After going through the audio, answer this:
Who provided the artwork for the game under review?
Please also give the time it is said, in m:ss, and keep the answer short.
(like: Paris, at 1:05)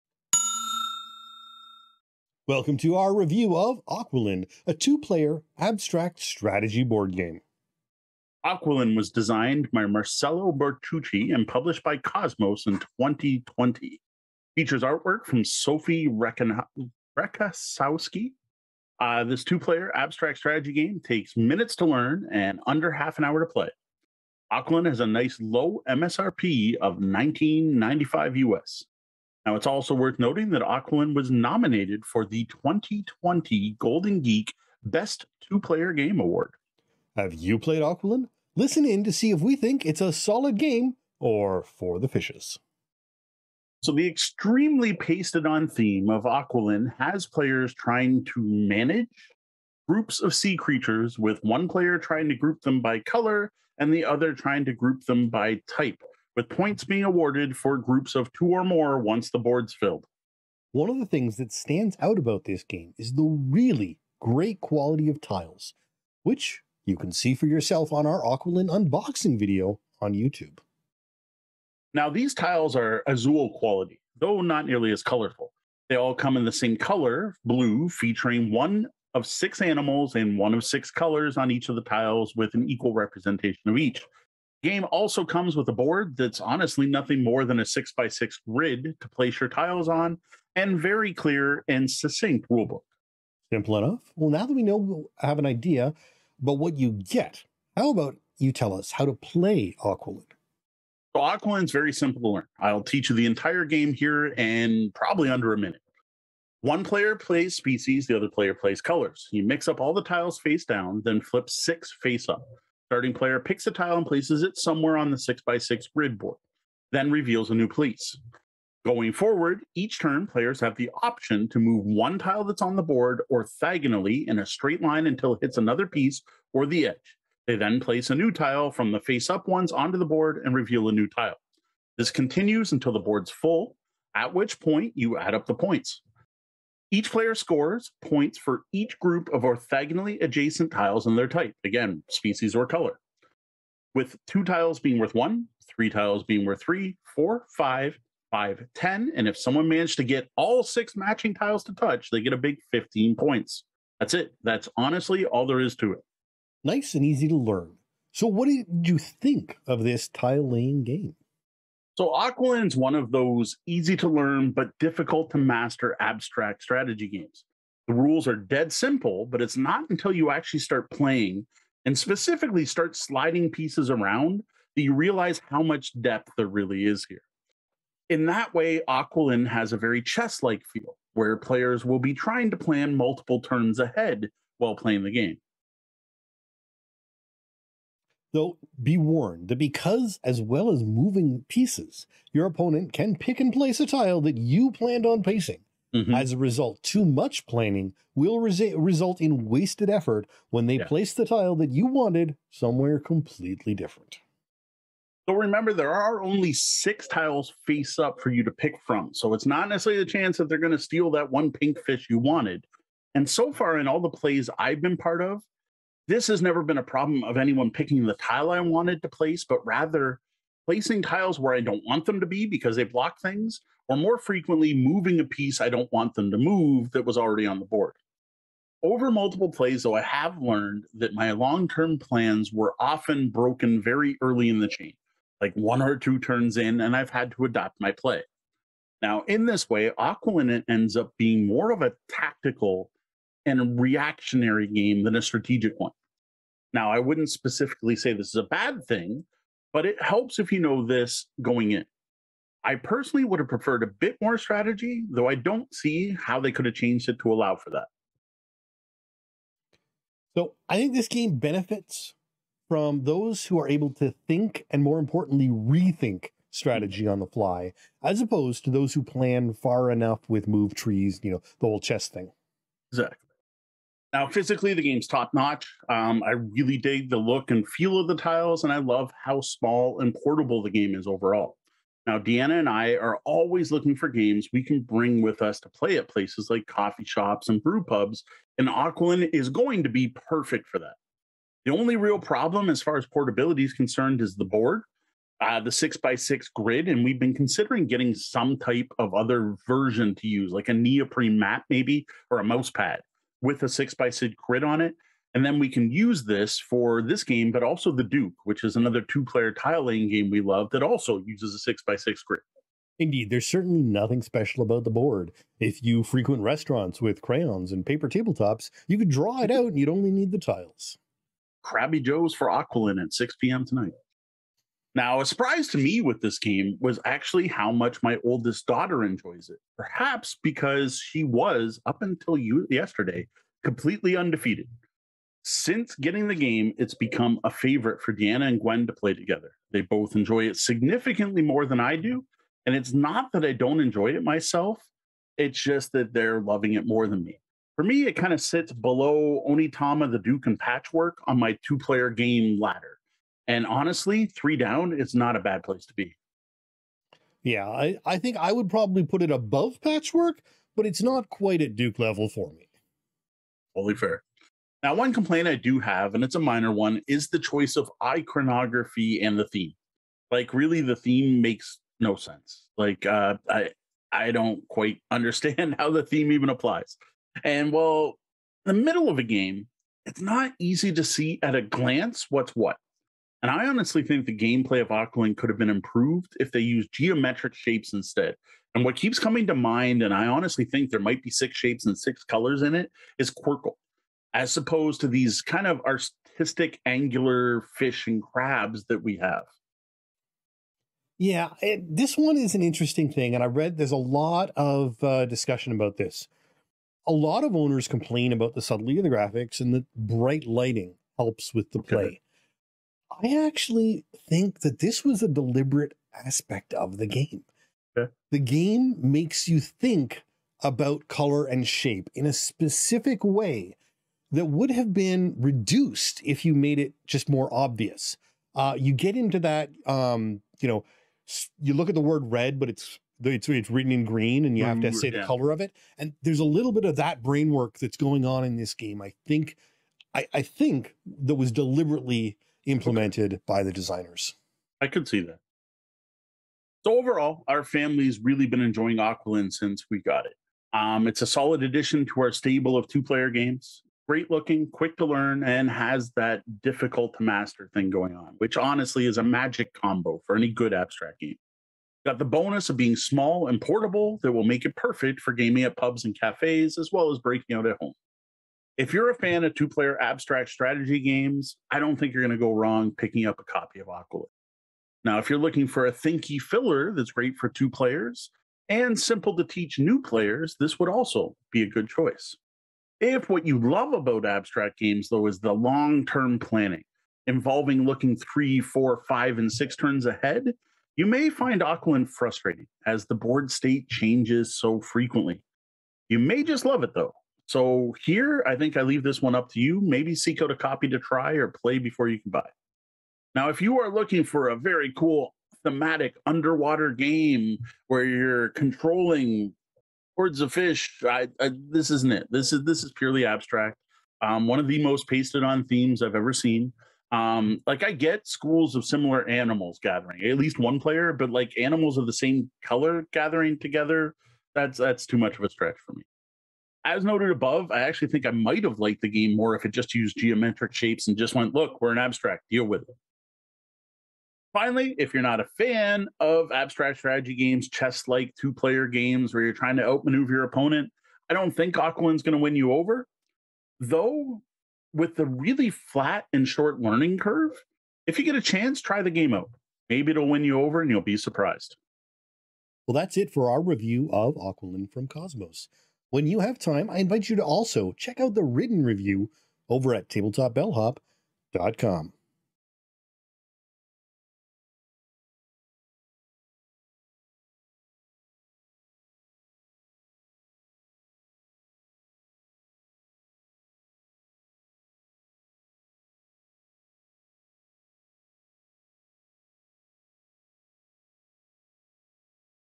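Sophie Rekasowski, at 0:15.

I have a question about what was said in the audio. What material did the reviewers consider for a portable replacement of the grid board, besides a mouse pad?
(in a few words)
neoprene mat.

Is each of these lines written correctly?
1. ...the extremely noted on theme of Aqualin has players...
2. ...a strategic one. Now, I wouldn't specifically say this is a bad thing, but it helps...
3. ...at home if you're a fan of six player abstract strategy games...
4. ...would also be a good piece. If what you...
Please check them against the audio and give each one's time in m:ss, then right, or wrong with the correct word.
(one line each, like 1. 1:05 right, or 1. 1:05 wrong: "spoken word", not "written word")
1. 0:43 wrong: "pasted", not "noted"
2. 4:05 right
3. 7:47 wrong: "two", not "six"
4. 8:00 wrong: "choice", not "piece".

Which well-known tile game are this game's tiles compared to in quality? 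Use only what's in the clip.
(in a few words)
Azul.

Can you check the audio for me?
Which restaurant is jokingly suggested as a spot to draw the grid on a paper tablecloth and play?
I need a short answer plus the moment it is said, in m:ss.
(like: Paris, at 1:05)
Crabby Joe's, at 5:21.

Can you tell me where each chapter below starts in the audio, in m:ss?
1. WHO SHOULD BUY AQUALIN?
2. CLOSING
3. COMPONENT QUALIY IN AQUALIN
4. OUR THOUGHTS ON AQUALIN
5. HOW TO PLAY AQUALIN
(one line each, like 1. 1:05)
1. 7:26
2. 9:12
3. 1:00
4. 2:36
5. 1:33.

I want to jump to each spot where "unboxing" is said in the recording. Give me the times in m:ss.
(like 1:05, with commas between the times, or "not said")
1:08.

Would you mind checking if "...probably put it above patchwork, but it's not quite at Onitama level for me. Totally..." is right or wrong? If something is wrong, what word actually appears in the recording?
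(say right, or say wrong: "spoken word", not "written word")
wrong: "Duke", not "Onitama".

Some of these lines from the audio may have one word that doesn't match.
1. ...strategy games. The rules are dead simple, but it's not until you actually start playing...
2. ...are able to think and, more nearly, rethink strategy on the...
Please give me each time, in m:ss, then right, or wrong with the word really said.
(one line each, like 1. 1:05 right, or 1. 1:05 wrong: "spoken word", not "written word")
1. 2:46 right
2. 4:23 wrong: "importantly", not "nearly".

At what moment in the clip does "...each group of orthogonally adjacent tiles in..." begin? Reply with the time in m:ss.
2:18.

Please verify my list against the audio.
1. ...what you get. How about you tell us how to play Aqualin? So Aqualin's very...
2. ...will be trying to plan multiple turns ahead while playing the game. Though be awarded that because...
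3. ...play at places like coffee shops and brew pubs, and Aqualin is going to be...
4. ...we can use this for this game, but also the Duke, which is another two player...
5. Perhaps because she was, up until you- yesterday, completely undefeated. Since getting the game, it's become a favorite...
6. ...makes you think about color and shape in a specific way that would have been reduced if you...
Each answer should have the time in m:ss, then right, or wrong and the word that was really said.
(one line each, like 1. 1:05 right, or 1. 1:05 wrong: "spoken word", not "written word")
1. 1:36 right
2. 3:01 wrong: "warned", not "awarded"
3. 4:45 right
4. 5:05 right
5. 5:29 right
6. 6:58 right.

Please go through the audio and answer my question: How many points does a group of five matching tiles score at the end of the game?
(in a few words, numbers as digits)
10.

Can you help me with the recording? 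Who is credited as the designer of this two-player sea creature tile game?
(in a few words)
Marcello Bertocchi.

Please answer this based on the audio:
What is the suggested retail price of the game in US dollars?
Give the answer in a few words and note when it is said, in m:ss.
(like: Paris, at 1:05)
$19.95, at 0:26.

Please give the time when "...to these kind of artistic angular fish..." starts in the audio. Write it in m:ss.
6:35.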